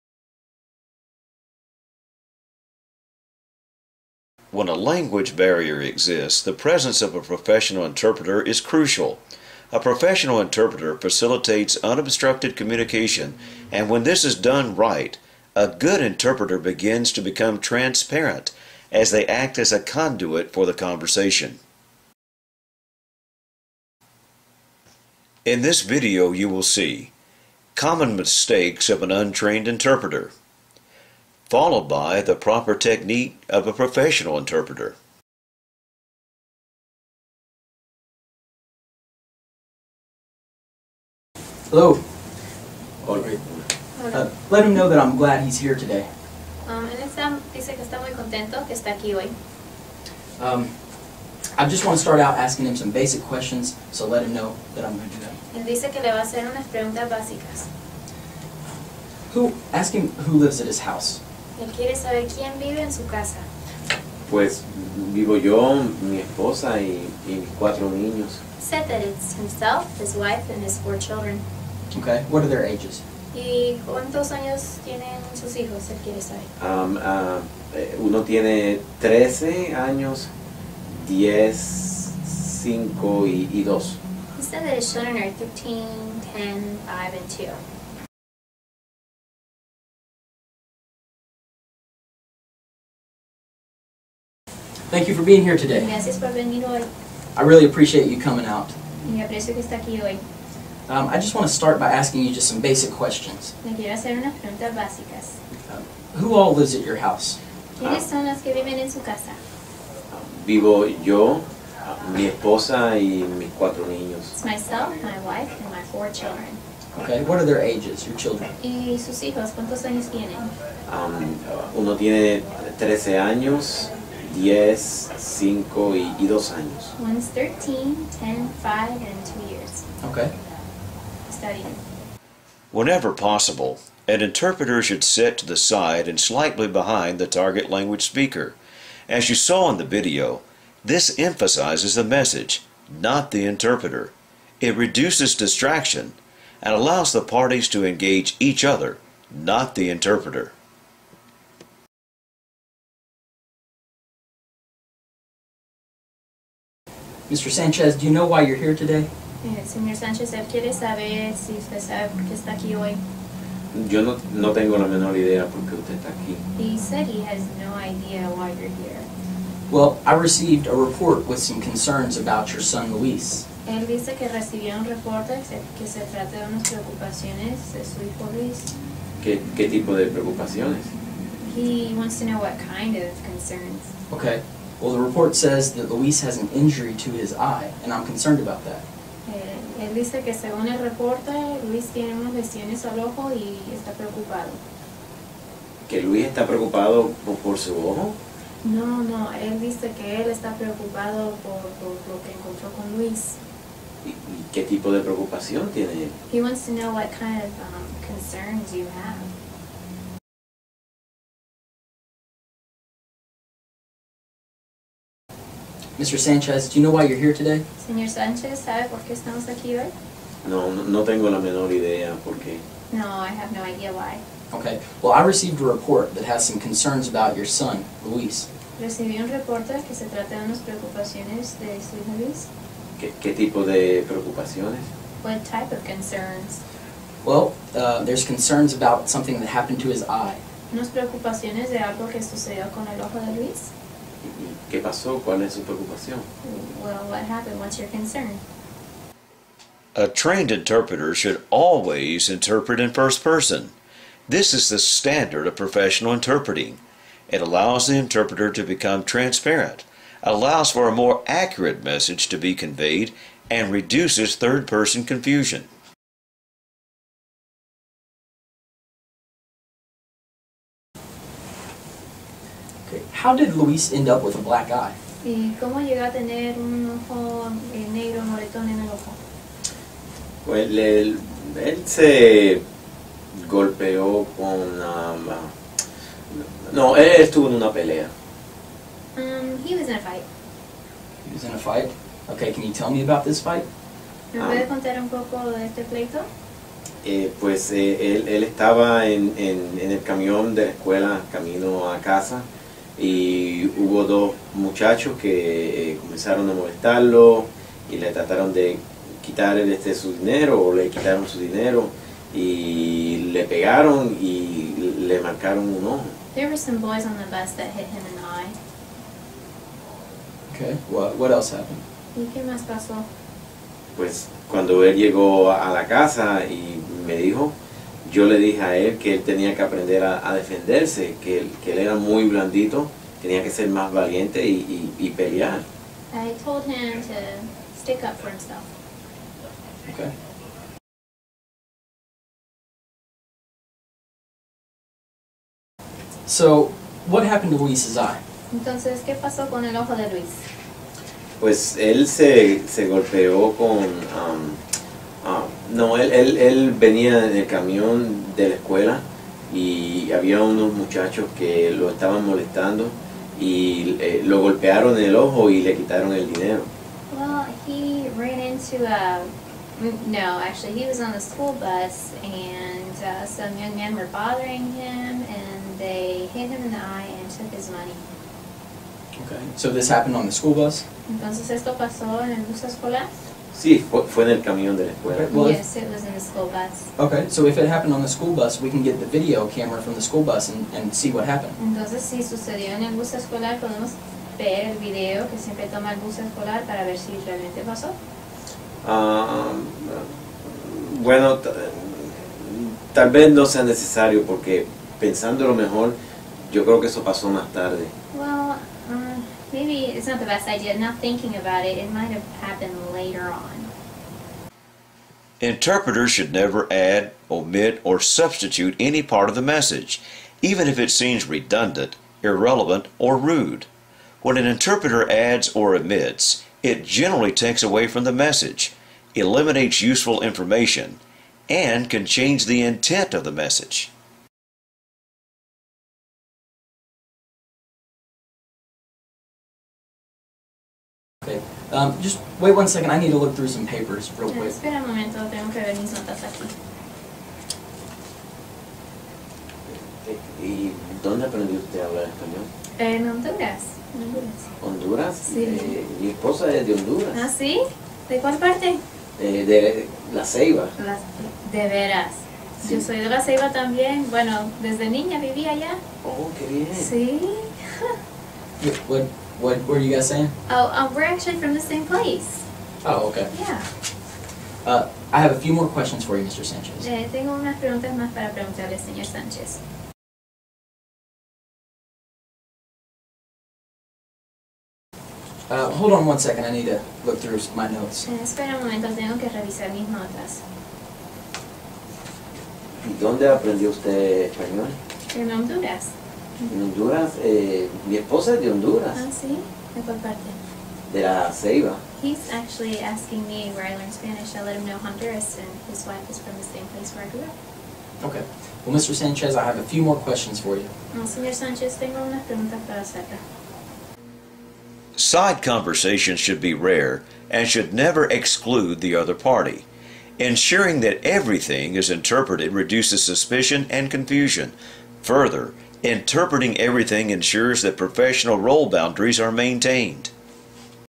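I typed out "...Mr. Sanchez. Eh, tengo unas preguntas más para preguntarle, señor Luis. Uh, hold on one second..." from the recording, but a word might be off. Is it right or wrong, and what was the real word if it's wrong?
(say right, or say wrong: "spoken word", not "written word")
wrong: "Sánchez", not "Luis".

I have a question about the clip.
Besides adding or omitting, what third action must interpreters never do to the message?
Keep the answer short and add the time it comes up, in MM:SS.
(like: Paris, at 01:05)
substitute, at 06:57.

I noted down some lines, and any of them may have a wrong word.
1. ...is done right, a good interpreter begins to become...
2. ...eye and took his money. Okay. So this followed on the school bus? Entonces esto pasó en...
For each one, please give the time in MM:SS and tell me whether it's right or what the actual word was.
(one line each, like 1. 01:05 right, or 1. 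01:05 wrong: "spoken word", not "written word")
1. 00:14 right
2. 06:16 wrong: "happened", not "followed".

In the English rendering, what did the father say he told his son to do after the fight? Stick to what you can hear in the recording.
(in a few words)
stick up for himself.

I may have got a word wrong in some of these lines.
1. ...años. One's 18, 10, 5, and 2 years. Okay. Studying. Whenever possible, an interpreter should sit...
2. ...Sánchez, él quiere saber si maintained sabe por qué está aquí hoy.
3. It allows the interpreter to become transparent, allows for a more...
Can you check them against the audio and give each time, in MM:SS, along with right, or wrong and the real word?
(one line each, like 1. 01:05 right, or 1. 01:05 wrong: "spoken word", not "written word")
1. 02:06 wrong: "13", not "18"
2. 02:39 wrong: "usted", not "maintained"
3. 04:17 right.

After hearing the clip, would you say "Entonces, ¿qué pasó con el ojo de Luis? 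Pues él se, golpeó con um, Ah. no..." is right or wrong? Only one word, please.
right.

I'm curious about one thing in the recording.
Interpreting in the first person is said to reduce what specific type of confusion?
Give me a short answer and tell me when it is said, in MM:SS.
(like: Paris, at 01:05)
third person confusion, at 04:24.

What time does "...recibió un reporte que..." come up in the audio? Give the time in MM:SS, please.
02:54.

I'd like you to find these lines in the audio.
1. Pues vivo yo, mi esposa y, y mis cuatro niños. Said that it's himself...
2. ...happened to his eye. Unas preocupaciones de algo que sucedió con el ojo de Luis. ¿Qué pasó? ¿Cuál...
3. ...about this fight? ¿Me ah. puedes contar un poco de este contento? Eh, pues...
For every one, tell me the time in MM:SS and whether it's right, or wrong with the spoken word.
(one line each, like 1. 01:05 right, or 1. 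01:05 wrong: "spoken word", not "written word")
1. 01:04 right
2. 03:59 right
3. 04:53 wrong: "pleito", not "contento".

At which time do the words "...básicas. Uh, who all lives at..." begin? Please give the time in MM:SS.
01:44.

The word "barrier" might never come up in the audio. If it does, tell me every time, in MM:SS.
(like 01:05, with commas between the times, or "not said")
00:05.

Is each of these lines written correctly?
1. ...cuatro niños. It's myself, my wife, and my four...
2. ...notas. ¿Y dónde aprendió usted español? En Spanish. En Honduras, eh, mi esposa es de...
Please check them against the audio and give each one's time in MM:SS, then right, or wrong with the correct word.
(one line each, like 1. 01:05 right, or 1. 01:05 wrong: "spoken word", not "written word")
1. 01:53 right
2. 08:09 wrong: "Honduras", not "Spanish".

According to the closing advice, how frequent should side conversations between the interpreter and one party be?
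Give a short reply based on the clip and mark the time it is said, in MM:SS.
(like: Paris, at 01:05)
rare, at 08:36.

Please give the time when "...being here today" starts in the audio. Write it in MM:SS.
01:35.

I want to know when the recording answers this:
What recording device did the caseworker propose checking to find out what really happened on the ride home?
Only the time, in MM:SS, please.
06:29.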